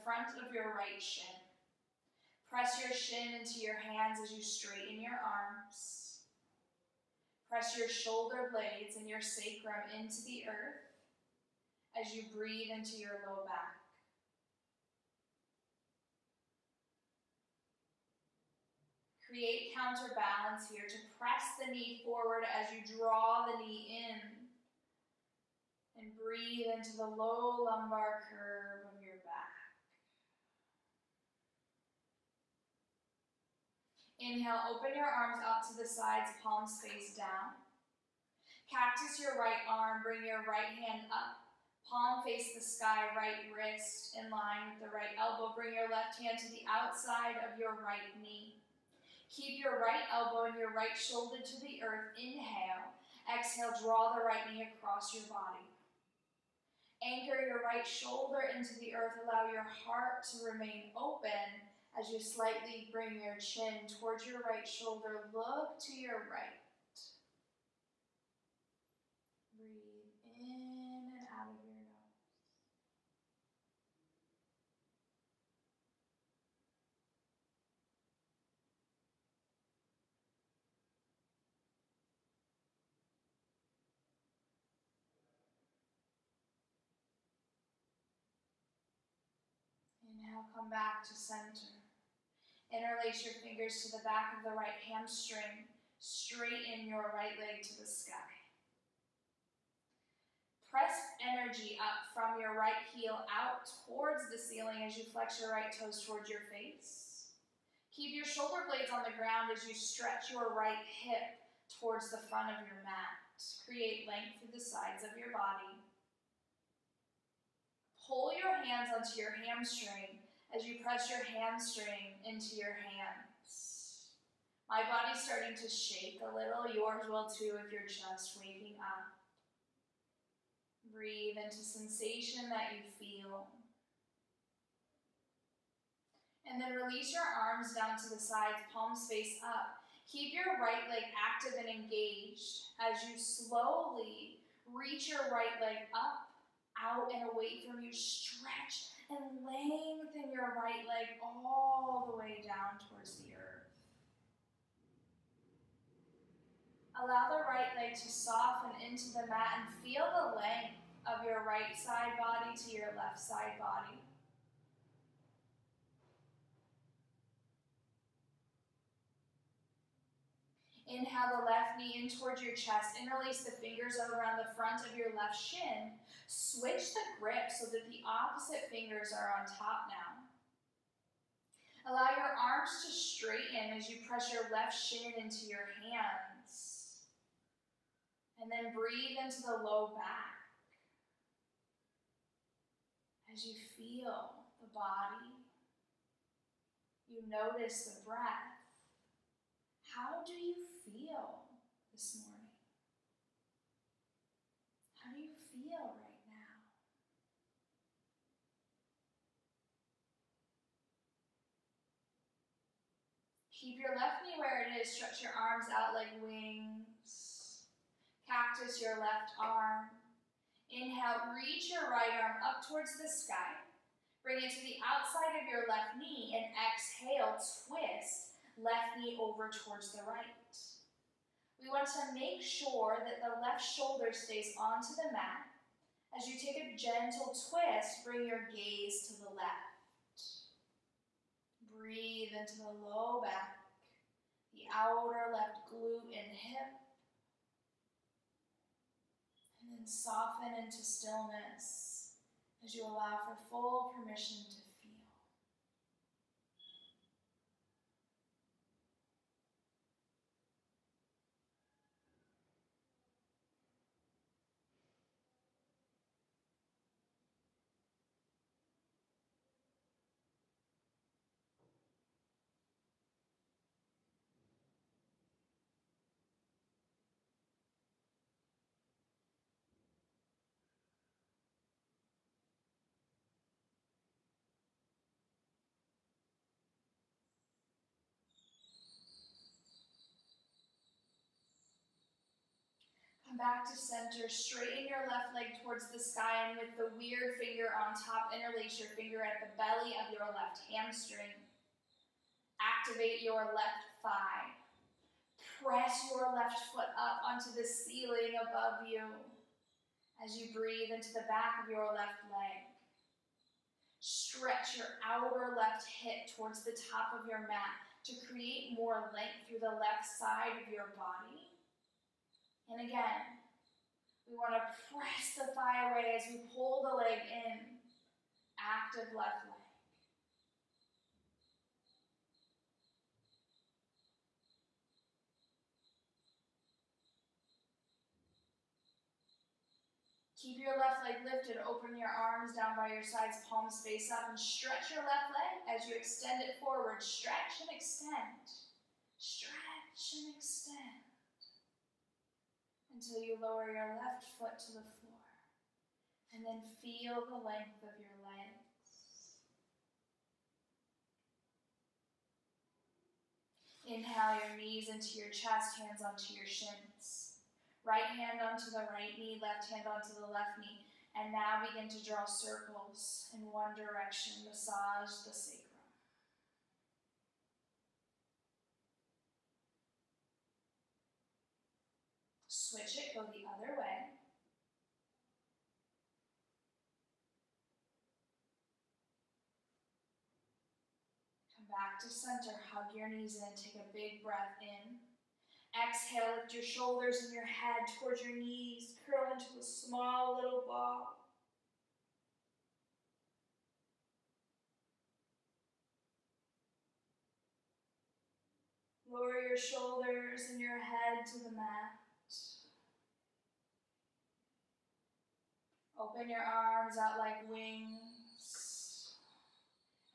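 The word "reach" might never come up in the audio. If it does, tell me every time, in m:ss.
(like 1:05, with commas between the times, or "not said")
2:24, 3:41.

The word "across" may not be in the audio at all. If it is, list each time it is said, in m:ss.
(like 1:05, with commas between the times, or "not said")
0:54.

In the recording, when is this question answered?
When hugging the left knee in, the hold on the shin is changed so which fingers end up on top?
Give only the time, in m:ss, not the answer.
2:58.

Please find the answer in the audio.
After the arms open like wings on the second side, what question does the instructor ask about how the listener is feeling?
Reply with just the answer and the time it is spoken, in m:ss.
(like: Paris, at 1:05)
How do you feel this morning?, at 3:19.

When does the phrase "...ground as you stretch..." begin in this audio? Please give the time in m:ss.
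1:49.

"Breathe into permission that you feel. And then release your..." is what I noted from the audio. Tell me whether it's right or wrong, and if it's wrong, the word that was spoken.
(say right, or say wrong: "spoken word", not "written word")
wrong: "sensation", not "permission".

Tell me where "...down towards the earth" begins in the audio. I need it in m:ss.
2:32.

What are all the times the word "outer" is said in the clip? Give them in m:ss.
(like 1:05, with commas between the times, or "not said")
4:04, 5:15.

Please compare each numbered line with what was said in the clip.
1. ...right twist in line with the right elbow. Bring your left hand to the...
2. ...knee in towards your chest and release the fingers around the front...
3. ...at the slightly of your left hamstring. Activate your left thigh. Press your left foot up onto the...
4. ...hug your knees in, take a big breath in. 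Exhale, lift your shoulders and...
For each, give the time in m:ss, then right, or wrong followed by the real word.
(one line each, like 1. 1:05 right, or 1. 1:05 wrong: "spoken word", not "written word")
1. 0:43 wrong: "wrist", not "twist"
2. 2:51 right
3. 4:59 wrong: "belly", not "slightly"
4. 6:32 right.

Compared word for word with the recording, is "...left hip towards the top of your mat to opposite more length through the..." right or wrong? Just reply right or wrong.
wrong.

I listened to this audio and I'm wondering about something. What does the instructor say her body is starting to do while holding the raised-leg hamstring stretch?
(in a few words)
Shake.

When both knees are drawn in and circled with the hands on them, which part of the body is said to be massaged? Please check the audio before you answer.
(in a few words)
The sacrum.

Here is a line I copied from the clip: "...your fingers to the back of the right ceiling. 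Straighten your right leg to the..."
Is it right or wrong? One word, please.
wrong.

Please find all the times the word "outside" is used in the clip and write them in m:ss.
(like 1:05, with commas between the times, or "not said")
0:46, 3:44.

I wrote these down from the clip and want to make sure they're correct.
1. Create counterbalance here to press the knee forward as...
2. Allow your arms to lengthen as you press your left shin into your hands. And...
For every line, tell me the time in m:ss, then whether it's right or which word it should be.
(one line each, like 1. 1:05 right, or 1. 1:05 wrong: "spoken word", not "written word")
1. 0:19 right
2. 3:01 wrong: "straighten", not "lengthen".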